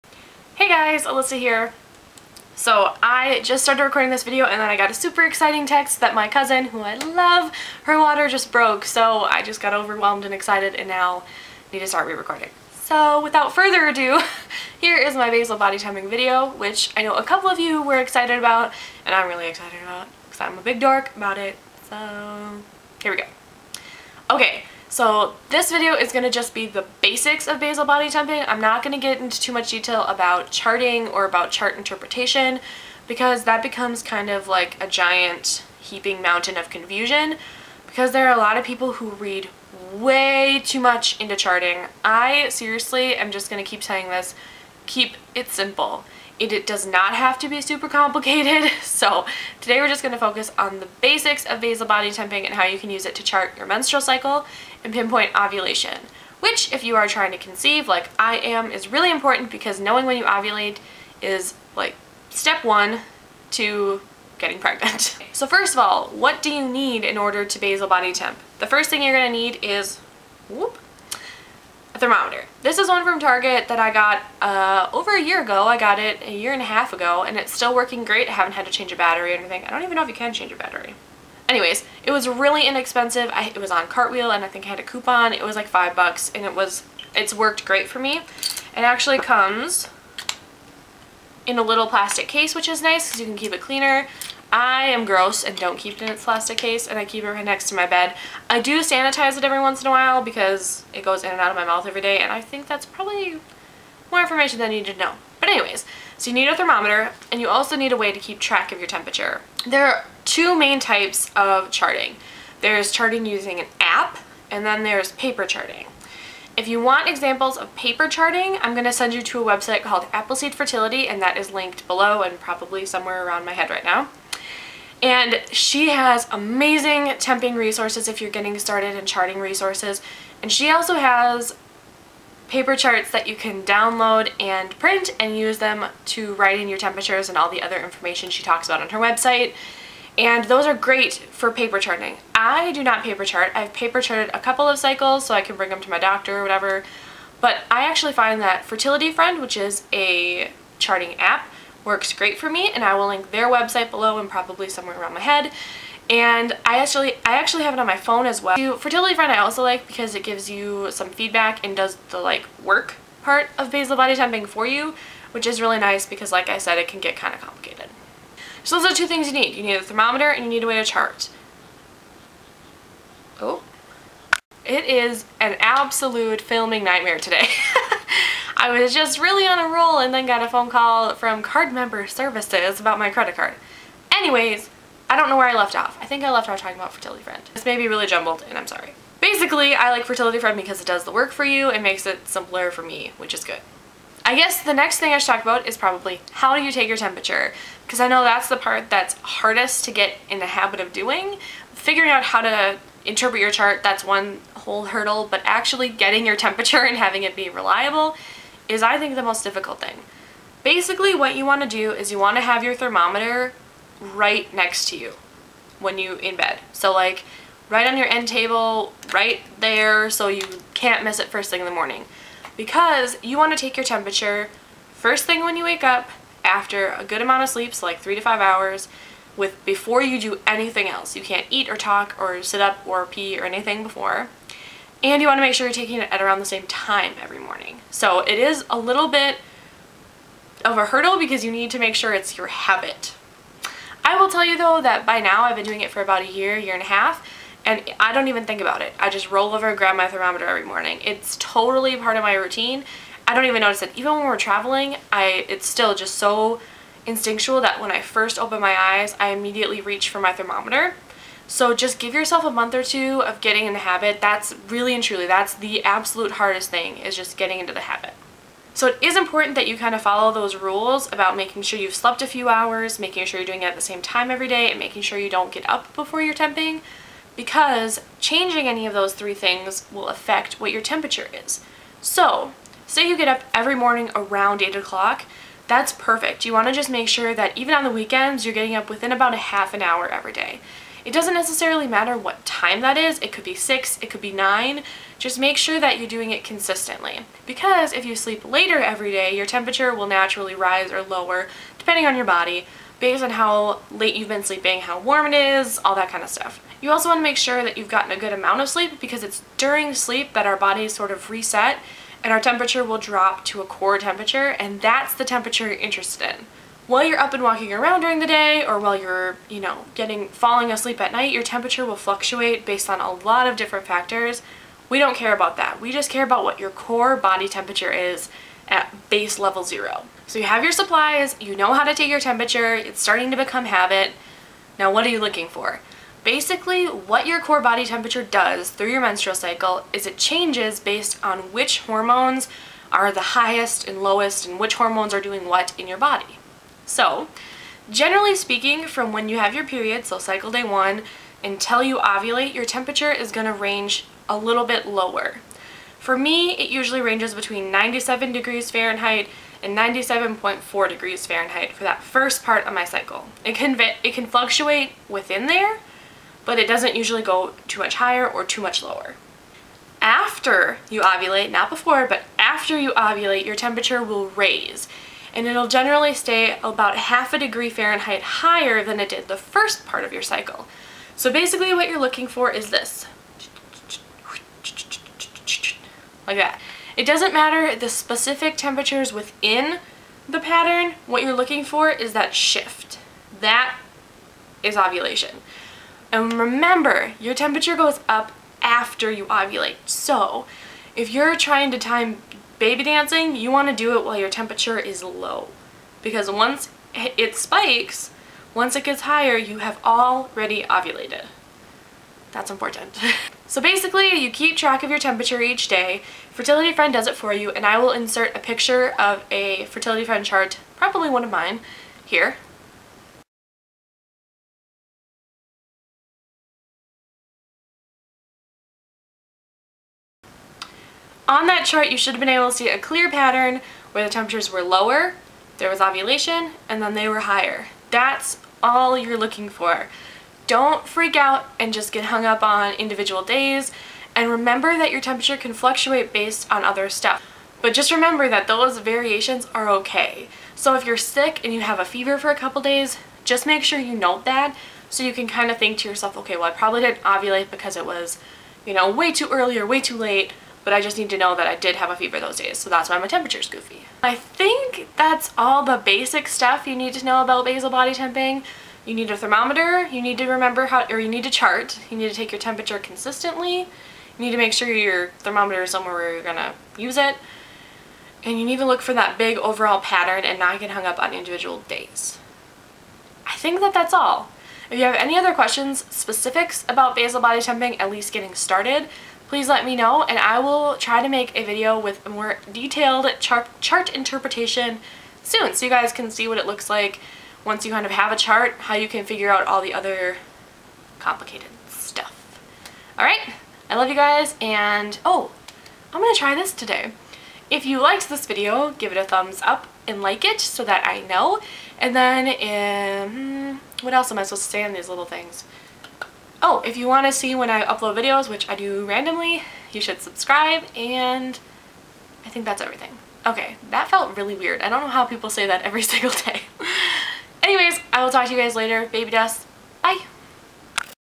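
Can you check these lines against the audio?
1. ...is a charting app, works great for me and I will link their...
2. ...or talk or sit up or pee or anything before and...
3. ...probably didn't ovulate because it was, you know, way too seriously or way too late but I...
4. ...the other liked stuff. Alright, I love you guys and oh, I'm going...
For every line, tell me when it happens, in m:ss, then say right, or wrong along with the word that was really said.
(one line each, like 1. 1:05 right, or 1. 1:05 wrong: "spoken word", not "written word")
1. 2:29 right
2. 3:51 right
3. 7:36 wrong: "early", not "seriously"
4. 8:19 wrong: "complicated", not "liked".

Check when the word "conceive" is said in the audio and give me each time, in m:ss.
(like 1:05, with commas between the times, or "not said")
0:57.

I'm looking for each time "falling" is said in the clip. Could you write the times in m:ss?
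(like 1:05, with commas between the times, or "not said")
5:20.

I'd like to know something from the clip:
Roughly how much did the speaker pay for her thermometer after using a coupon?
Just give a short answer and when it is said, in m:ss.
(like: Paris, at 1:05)
5 dollars, at 1:25.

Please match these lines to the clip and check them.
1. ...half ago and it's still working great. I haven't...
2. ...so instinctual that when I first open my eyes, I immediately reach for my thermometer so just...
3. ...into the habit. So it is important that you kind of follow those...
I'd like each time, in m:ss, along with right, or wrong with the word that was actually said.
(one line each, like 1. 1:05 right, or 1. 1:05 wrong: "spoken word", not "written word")
1. 1:16 right
2. 4:16 right
3. 4:27 right.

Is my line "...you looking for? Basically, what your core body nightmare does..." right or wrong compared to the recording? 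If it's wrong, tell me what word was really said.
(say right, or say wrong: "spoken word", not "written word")
wrong: "temperature", not "nightmare".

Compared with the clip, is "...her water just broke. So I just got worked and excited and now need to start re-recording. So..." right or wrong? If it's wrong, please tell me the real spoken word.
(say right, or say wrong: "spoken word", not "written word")
wrong: "overwhelmed", not "worked".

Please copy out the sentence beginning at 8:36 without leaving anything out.
Oh, if you want to see when I upload videos, which I do randomly, you should subscribe, and I think that's everything.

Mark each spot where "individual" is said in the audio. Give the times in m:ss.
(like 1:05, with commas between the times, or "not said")
7:22, 8:01.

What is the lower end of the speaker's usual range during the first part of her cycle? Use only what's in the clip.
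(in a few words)
97 degrees Fahrenheit.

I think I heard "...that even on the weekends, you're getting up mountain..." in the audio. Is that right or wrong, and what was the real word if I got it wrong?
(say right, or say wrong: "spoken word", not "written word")
wrong: "within", not "mountain".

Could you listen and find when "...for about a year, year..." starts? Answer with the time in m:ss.
4:05.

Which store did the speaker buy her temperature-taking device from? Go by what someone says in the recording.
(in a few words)
Target.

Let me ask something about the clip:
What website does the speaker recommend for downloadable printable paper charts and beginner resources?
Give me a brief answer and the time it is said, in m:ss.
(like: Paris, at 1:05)
Appleseed Fertility, at 2:00.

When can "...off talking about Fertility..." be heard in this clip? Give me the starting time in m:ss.
3:06.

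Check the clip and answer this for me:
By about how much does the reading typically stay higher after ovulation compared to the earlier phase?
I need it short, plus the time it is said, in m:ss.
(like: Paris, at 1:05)
Half a degree Fahrenheit, at 6:16.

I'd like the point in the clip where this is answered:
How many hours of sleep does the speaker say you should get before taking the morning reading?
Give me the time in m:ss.
3:47.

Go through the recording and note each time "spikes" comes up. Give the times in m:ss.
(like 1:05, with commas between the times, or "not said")
6:47.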